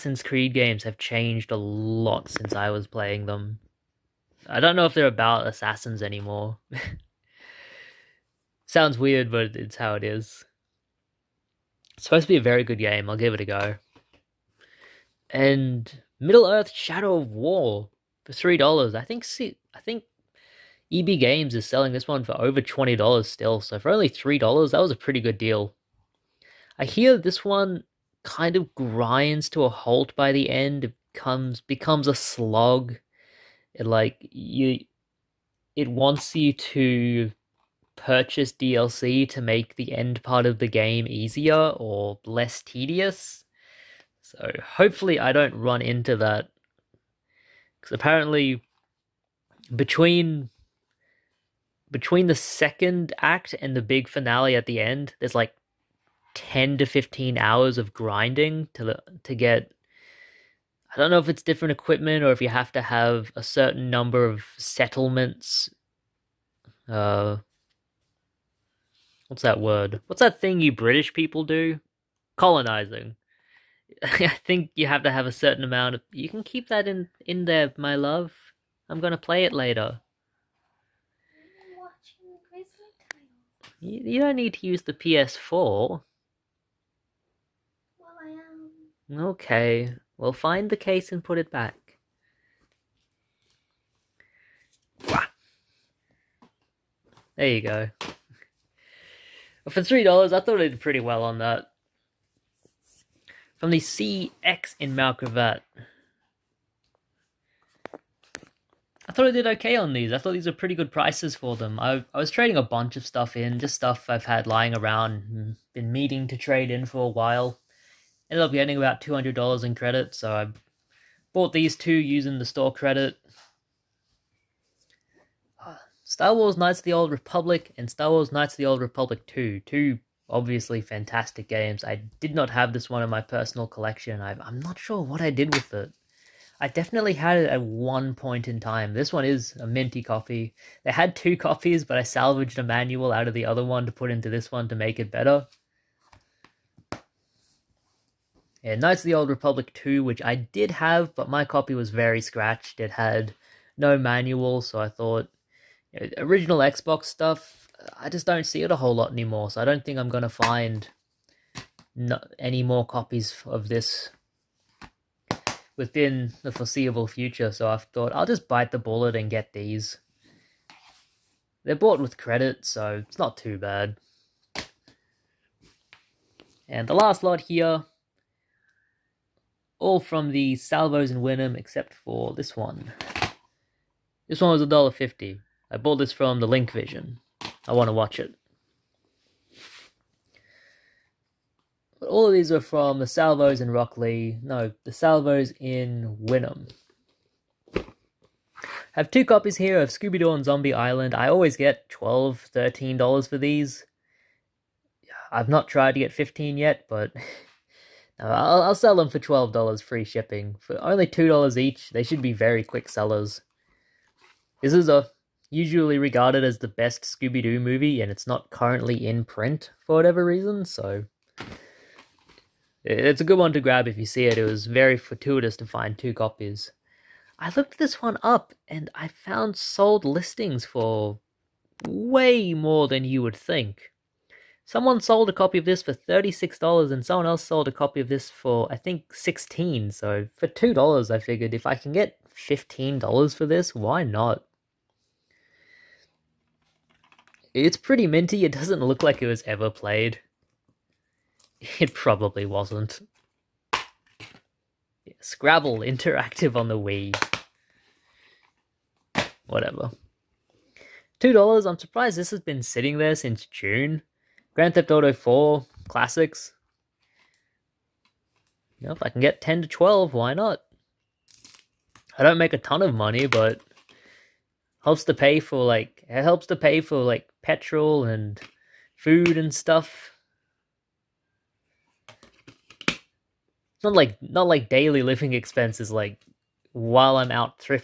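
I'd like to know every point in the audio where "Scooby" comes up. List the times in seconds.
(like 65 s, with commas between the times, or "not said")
199 s, 217 s.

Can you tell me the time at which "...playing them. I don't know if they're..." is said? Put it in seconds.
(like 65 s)
2 s.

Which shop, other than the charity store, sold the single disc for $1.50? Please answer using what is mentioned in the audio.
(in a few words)
Link Vision.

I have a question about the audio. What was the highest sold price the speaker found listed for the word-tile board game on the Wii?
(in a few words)
$36.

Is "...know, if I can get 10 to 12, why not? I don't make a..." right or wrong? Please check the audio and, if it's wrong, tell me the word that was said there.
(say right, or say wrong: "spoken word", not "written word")
right.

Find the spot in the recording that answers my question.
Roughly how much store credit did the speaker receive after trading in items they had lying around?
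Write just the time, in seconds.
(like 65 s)
119 s.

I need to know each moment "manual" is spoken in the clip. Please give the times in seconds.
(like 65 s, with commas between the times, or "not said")
142 s, 153 s.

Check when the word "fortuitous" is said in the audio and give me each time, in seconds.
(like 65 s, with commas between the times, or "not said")
224 s.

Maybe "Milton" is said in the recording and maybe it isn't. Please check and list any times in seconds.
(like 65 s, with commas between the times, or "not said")
not said.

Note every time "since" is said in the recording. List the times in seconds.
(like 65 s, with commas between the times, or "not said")
2 s, 263 s.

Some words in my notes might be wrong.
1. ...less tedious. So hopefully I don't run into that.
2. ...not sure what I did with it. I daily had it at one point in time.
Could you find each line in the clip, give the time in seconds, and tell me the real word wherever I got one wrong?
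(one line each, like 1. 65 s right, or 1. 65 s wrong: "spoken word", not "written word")
1. 42 s right
2. 134 s wrong: "definitely", not "daily".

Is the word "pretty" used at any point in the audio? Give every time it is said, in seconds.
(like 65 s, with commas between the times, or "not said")
24 s, 100 s, 110 s, 247 s.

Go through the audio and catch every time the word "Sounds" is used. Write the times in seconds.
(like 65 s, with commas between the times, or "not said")
8 s.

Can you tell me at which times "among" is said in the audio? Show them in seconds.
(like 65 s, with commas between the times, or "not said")
not said.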